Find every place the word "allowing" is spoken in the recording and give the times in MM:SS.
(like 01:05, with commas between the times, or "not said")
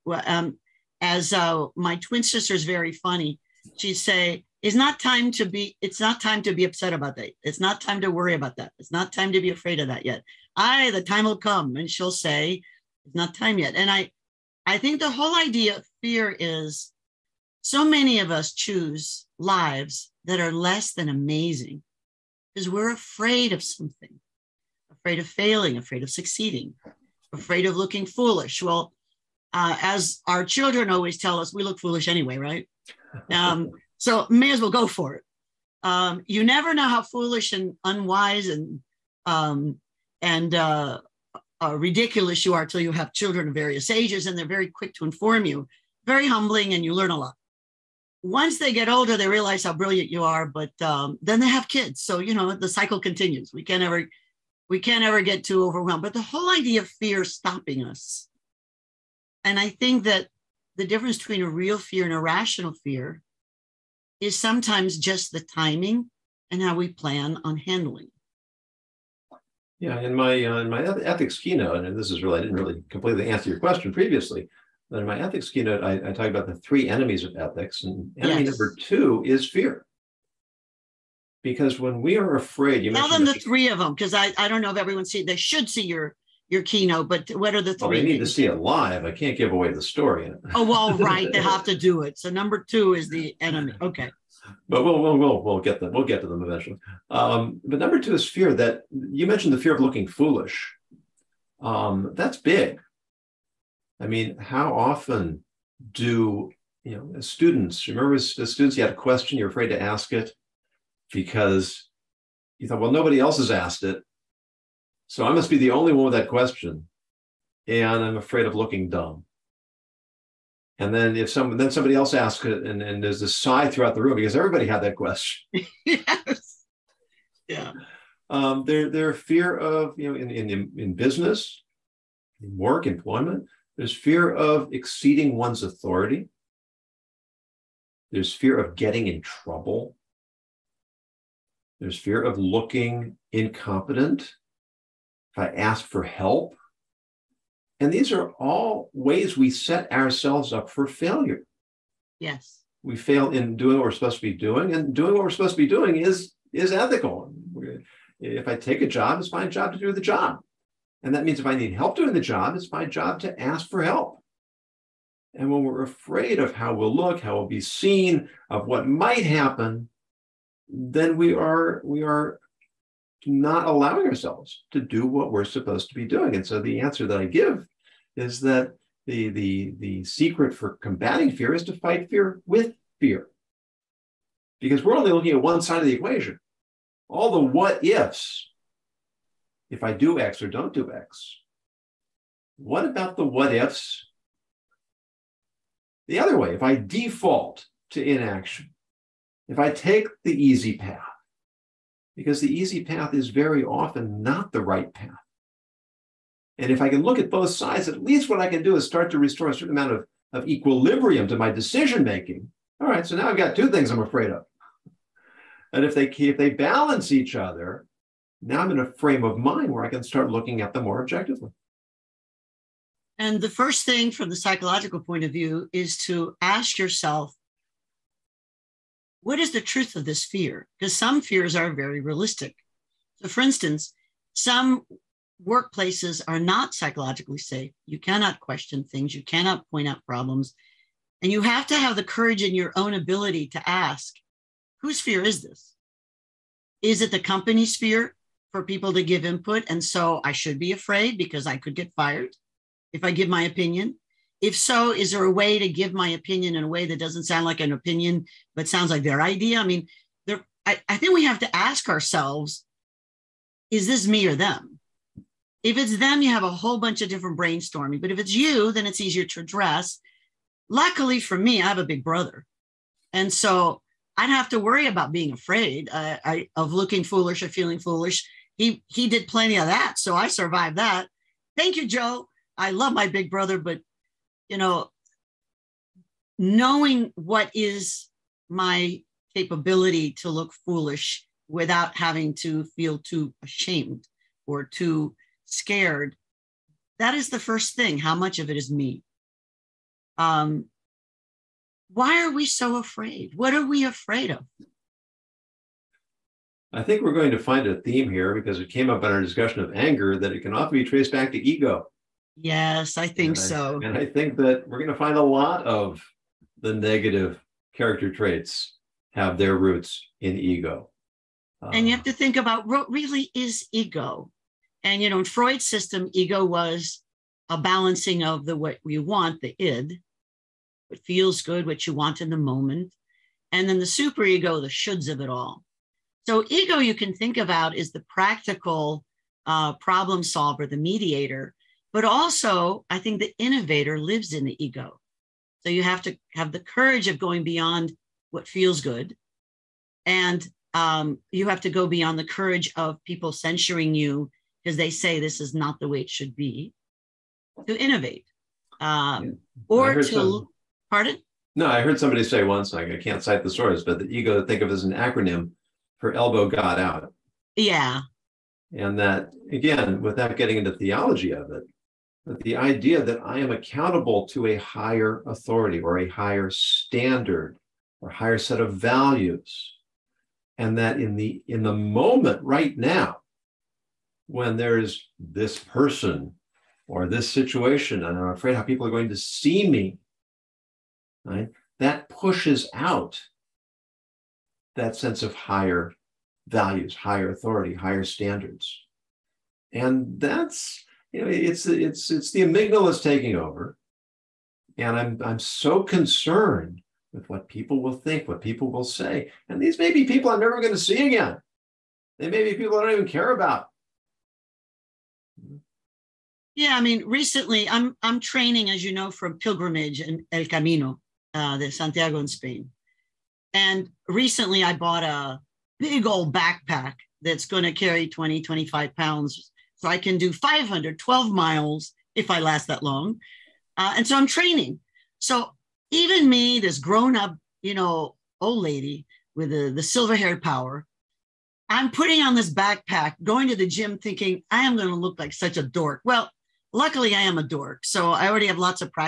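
02:53.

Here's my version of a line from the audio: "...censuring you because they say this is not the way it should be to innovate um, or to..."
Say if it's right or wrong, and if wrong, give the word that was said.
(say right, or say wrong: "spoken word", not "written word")
right.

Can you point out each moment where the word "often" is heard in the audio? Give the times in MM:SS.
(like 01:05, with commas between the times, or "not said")
01:44, 03:23, 05:10.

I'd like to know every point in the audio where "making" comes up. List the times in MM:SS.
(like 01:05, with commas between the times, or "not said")
03:32.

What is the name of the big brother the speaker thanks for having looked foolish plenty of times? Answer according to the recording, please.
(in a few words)
Joe.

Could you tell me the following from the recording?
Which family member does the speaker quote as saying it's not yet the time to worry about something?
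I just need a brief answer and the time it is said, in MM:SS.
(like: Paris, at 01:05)
Twin sister, at 00:01.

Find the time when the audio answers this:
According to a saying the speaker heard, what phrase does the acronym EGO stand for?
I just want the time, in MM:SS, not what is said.
06:06.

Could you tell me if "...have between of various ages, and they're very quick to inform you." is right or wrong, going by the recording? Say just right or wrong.
wrong.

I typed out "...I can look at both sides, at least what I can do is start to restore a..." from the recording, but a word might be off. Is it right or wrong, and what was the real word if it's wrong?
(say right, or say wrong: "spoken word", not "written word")
right.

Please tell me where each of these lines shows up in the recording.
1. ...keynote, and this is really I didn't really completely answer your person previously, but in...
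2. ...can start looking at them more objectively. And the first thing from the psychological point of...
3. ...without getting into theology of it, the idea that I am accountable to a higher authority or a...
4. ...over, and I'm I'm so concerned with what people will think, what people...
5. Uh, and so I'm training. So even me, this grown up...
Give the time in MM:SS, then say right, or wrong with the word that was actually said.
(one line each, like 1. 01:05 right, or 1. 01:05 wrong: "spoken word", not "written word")
1. 01:11 wrong: "question", not "person"
2. 03:39 right
3. 06:10 right
4. 06:43 right
5. 07:13 right.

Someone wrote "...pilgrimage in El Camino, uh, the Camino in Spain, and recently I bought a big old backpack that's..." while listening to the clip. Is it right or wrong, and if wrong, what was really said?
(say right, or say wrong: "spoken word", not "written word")
wrong: "Santiago", not "Camino".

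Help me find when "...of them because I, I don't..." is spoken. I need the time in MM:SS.
01:23.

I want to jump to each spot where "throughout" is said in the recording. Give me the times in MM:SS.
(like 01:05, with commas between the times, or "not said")
02:03.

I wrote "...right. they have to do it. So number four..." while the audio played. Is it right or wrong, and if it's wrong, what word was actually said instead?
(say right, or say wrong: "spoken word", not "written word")
wrong: "two", not "four".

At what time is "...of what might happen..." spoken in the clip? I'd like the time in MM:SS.
02:48.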